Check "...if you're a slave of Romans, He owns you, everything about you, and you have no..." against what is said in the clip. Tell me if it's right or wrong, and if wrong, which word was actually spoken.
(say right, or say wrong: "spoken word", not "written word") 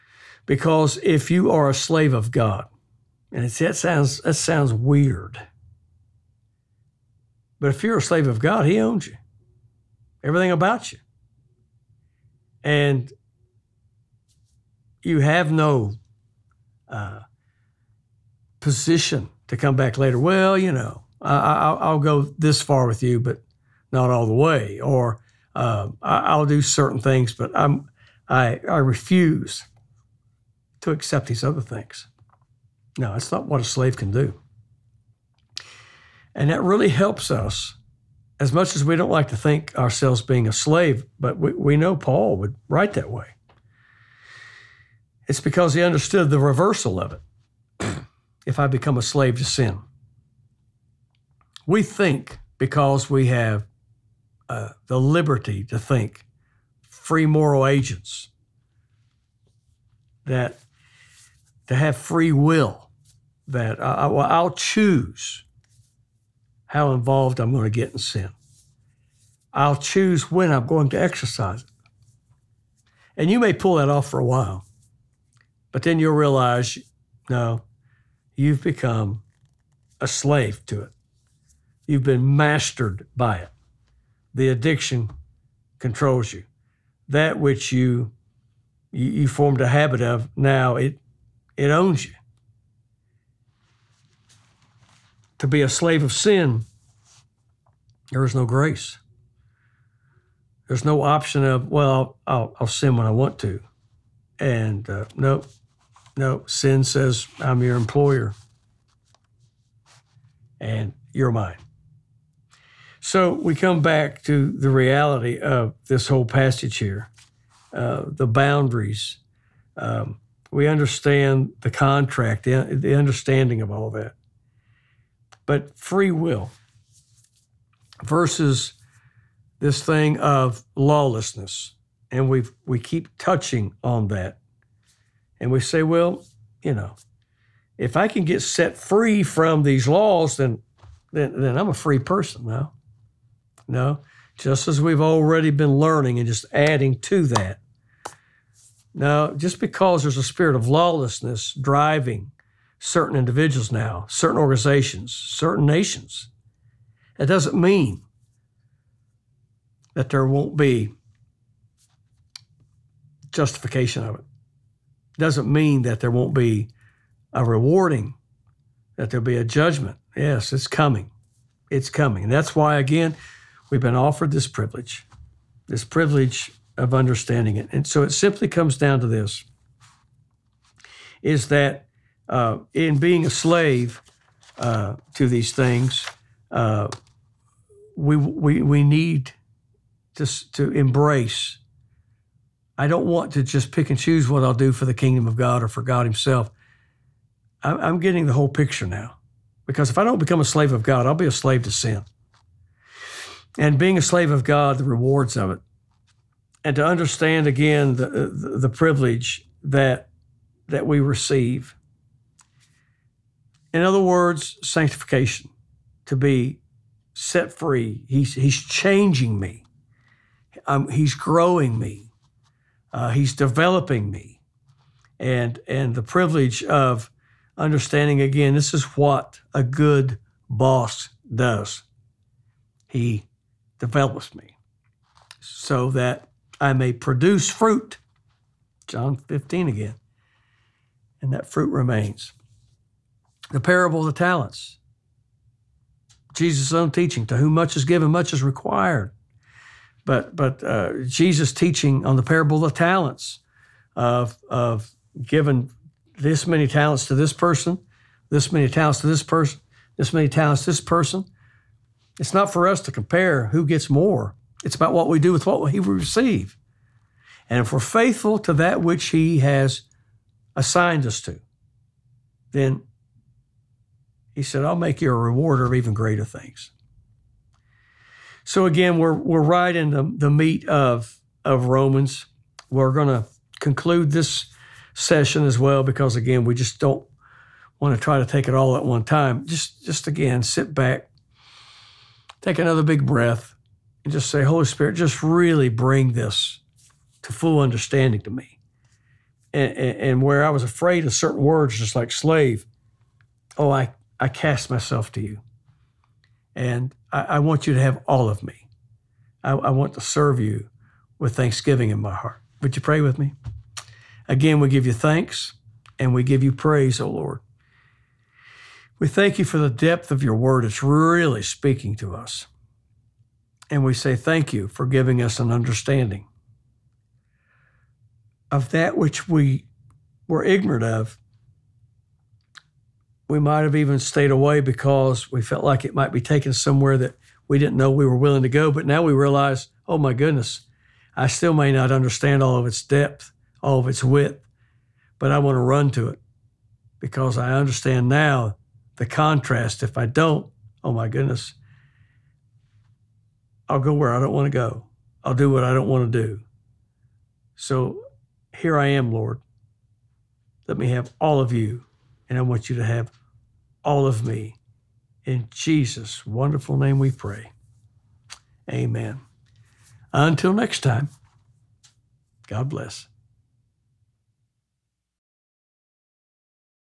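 wrong: "God", not "Romans".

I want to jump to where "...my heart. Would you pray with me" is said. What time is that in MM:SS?
05:11.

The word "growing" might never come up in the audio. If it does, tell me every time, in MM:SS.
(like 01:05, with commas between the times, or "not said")
03:41.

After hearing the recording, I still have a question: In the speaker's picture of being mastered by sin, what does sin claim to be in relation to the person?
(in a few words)
Your employer.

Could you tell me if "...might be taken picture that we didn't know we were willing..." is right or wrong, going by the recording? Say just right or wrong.
wrong.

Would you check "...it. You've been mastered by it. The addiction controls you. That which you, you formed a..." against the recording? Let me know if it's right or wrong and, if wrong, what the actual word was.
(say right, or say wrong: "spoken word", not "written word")
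right.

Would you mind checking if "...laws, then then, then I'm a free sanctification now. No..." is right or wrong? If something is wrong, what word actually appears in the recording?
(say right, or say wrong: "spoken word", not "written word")
wrong: "person", not "sanctification".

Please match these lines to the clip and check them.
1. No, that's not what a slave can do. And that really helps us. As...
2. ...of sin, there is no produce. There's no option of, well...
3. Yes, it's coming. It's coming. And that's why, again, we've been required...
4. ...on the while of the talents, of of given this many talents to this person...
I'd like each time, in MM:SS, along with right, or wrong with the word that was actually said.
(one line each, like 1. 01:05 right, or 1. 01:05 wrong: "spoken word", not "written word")
1. 00:32 right
2. 01:36 wrong: "grace", not "produce"
3. 02:50 wrong: "offered", not "required"
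4. 04:12 wrong: "parable", not "while".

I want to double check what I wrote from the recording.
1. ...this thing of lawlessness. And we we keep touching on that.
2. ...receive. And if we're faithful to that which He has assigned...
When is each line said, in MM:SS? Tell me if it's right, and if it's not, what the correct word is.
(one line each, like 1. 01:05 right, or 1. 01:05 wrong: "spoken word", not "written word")
1. 02:09 right
2. 04:25 right.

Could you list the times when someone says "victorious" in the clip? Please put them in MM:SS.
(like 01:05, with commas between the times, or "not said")
not said.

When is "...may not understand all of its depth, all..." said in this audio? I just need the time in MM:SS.
05:41.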